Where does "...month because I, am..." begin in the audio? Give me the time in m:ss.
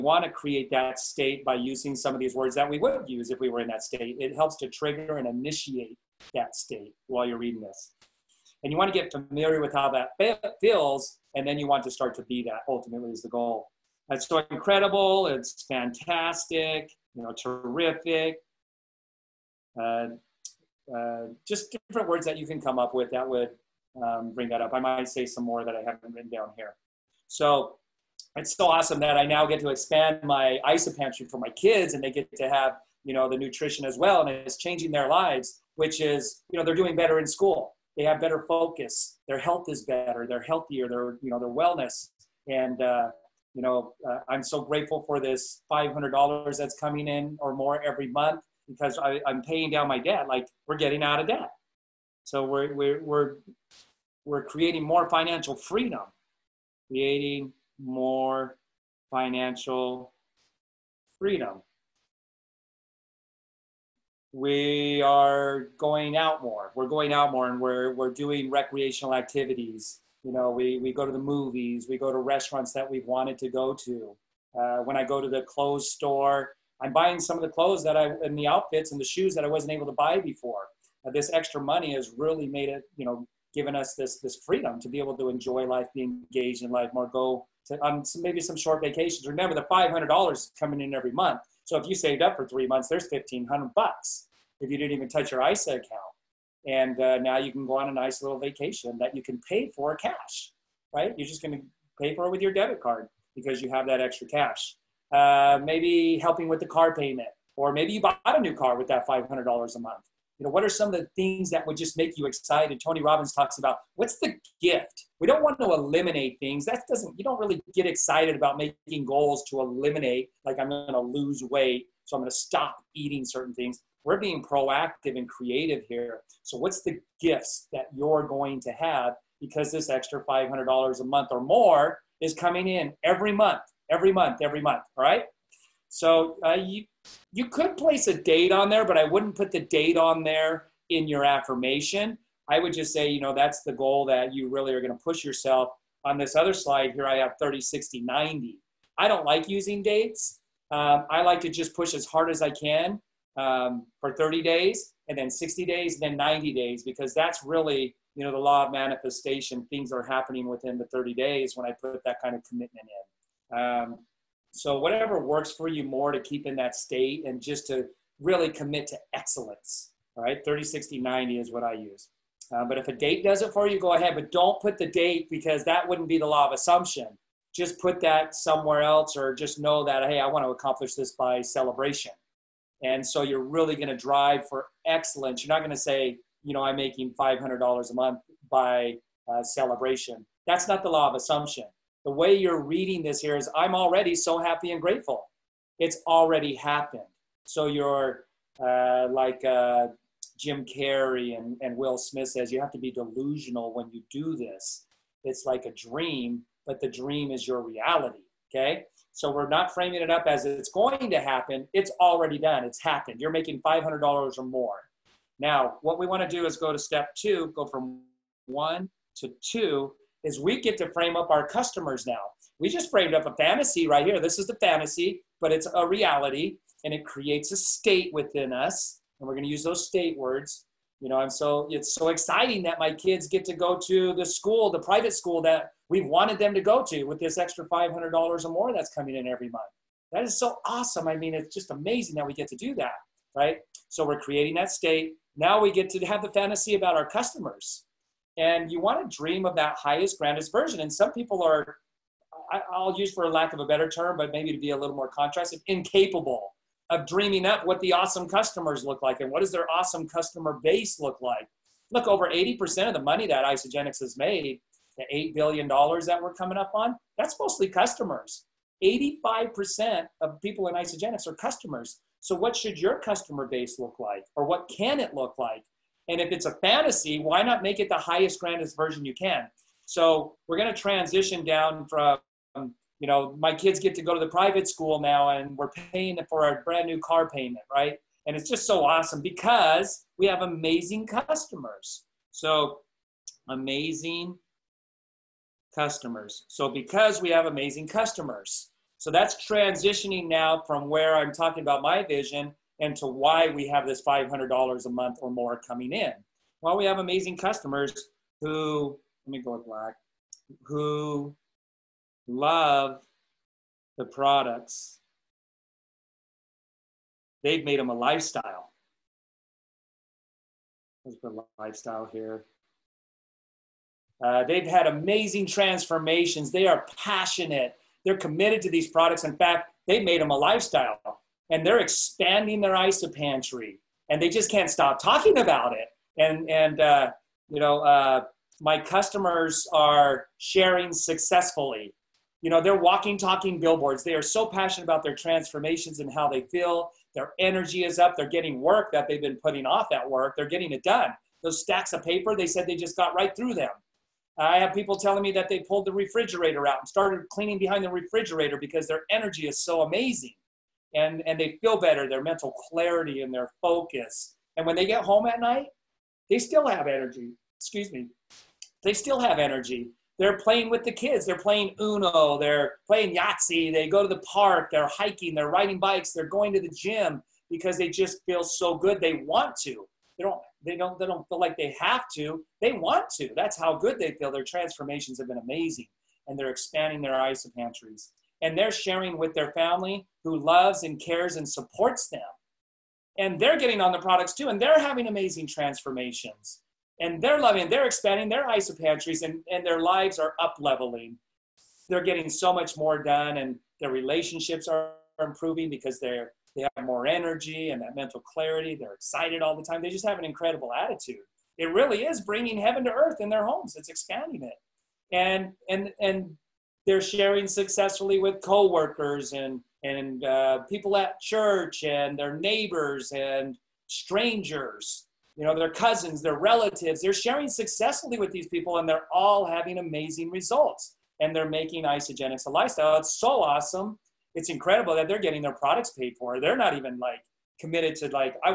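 0:48.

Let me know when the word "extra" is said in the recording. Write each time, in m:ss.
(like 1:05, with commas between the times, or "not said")
1:21, 1:43, 2:09, 3:57.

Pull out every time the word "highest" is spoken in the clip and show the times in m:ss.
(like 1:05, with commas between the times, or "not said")
4:09, 4:37.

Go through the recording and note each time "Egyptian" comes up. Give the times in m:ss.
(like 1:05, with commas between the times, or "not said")
not said.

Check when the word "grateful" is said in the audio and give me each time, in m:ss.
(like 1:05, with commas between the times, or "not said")
0:44, 3:14.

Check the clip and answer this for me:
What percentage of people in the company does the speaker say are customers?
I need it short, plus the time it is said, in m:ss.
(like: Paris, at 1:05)
85%, at 4:28.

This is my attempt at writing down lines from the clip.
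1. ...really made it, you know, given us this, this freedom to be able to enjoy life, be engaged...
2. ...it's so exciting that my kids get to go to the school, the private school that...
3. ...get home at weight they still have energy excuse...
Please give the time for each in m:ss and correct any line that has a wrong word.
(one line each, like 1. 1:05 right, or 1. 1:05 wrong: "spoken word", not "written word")
1. 1:22 right
2. 3:51 right
3. 6:04 wrong: "night", not "weight".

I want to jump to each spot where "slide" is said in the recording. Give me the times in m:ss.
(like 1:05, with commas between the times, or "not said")
2:26.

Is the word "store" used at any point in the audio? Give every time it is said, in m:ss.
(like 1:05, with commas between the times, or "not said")
1:15.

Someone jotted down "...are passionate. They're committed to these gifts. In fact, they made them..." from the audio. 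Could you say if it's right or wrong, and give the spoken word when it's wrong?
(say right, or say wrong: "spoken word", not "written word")
wrong: "products", not "gifts".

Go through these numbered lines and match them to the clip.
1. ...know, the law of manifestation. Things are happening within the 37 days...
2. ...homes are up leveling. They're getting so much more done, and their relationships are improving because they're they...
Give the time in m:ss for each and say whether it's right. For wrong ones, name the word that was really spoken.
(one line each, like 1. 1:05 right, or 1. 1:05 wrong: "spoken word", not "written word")
1. 2:38 wrong: "30", not "37"
2. 6:39 wrong: "lives", not "homes".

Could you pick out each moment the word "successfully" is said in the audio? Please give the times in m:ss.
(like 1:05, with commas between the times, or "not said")
5:40, 6:57, 7:07.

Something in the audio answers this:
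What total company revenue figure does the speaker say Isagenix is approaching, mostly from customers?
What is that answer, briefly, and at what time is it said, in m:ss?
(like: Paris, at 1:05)
$8 billion, at 4:25.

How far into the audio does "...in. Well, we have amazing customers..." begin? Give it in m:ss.
5:05.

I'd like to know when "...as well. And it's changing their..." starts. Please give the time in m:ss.
0:33.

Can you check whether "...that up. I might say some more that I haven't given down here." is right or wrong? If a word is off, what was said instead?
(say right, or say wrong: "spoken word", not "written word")
wrong: "written", not "given".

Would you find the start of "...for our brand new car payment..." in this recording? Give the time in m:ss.
4:46.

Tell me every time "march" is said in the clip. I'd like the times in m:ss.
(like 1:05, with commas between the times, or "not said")
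not said.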